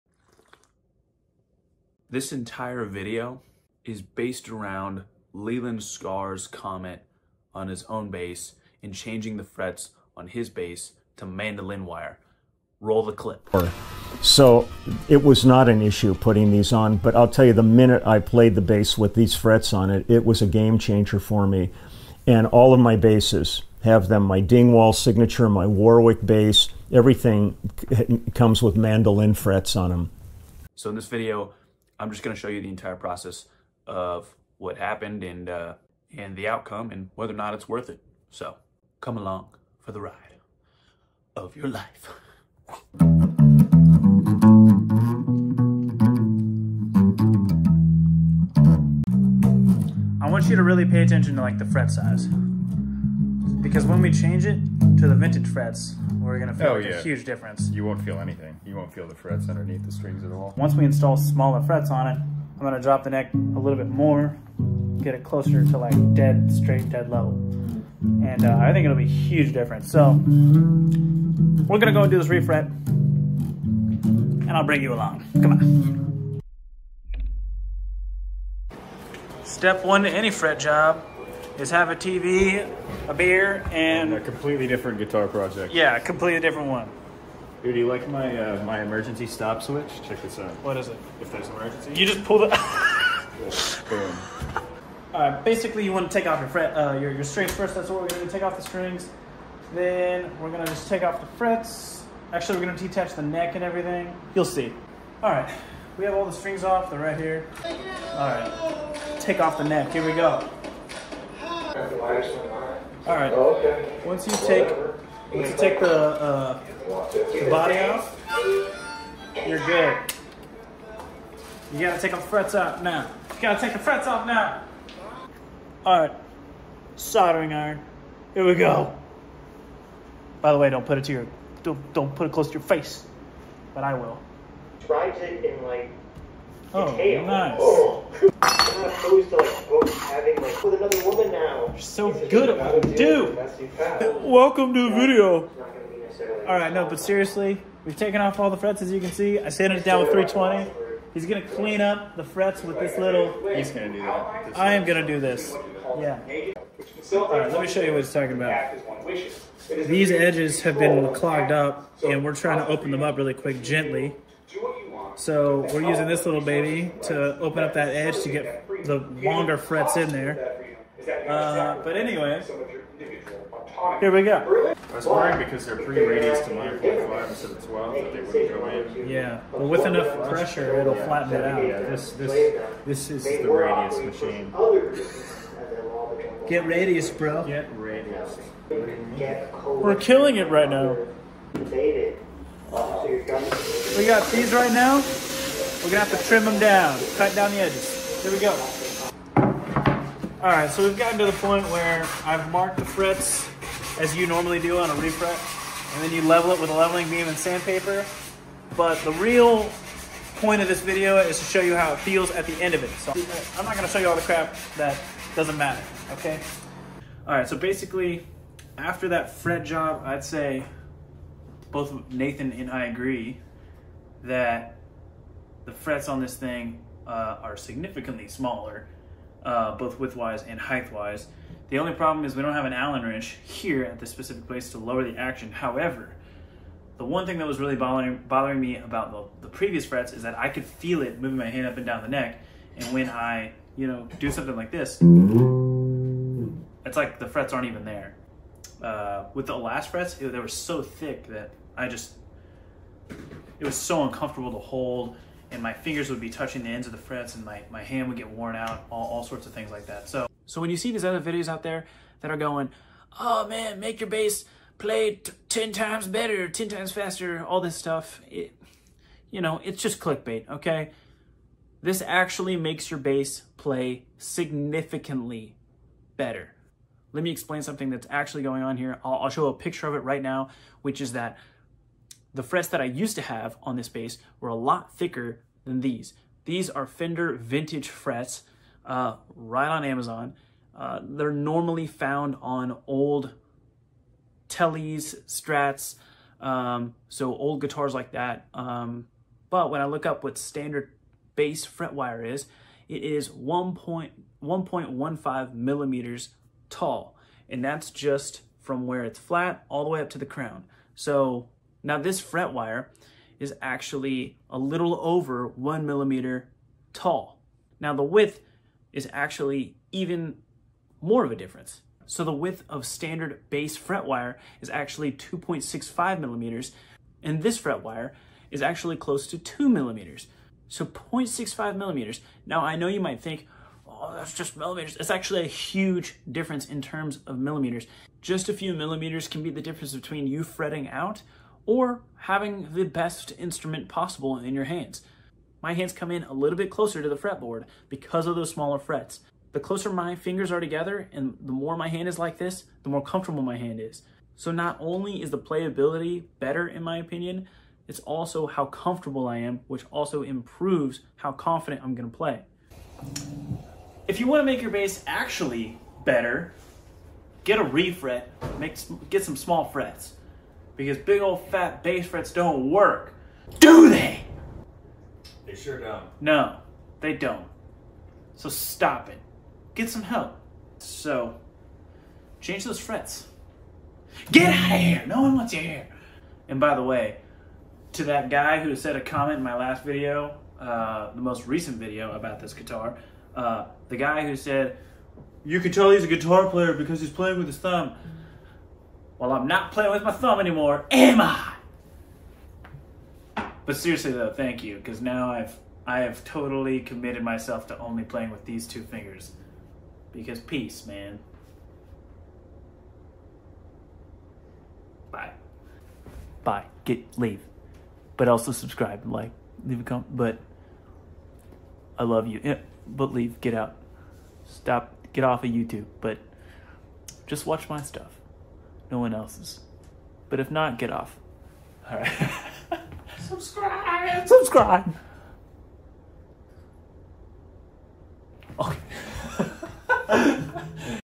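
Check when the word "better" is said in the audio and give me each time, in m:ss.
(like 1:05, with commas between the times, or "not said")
4:26, 4:36, 5:56, 6:06.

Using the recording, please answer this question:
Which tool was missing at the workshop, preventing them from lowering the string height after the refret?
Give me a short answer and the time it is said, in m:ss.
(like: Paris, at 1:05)
Allen wrench, at 3:52.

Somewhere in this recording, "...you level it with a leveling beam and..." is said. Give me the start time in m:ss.
3:26.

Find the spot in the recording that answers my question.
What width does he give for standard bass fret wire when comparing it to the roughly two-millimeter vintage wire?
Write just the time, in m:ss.
5:25.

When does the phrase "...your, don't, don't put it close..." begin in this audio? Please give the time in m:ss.
2:11.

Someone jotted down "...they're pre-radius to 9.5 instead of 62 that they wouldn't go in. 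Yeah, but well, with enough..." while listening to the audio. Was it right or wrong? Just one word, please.
wrong.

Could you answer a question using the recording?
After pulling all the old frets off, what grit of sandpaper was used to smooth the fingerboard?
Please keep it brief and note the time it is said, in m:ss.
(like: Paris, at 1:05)
320, at 2:30.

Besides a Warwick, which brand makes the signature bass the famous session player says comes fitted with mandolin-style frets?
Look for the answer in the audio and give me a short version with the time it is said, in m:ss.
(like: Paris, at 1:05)
Dingwall, at 0:24.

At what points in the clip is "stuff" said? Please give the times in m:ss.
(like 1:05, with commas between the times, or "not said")
4:27, 7:07.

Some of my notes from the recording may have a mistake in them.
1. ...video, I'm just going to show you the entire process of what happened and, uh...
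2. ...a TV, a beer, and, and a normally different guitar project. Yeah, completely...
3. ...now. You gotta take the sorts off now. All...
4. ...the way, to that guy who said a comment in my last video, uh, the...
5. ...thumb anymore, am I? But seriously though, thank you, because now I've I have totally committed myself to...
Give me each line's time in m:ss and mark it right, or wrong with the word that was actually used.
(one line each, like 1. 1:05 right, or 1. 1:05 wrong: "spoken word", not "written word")
1. 0:31 right
2. 1:21 wrong: "completely", not "normally"
3. 2:02 wrong: "frets", not "sorts"
4. 6:26 right
5. 6:40 right.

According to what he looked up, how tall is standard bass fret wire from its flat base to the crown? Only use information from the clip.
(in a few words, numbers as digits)
1.15 millimeters.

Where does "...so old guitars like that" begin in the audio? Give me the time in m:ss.
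4:57.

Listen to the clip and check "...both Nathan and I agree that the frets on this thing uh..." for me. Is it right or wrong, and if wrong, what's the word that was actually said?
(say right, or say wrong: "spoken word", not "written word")
right.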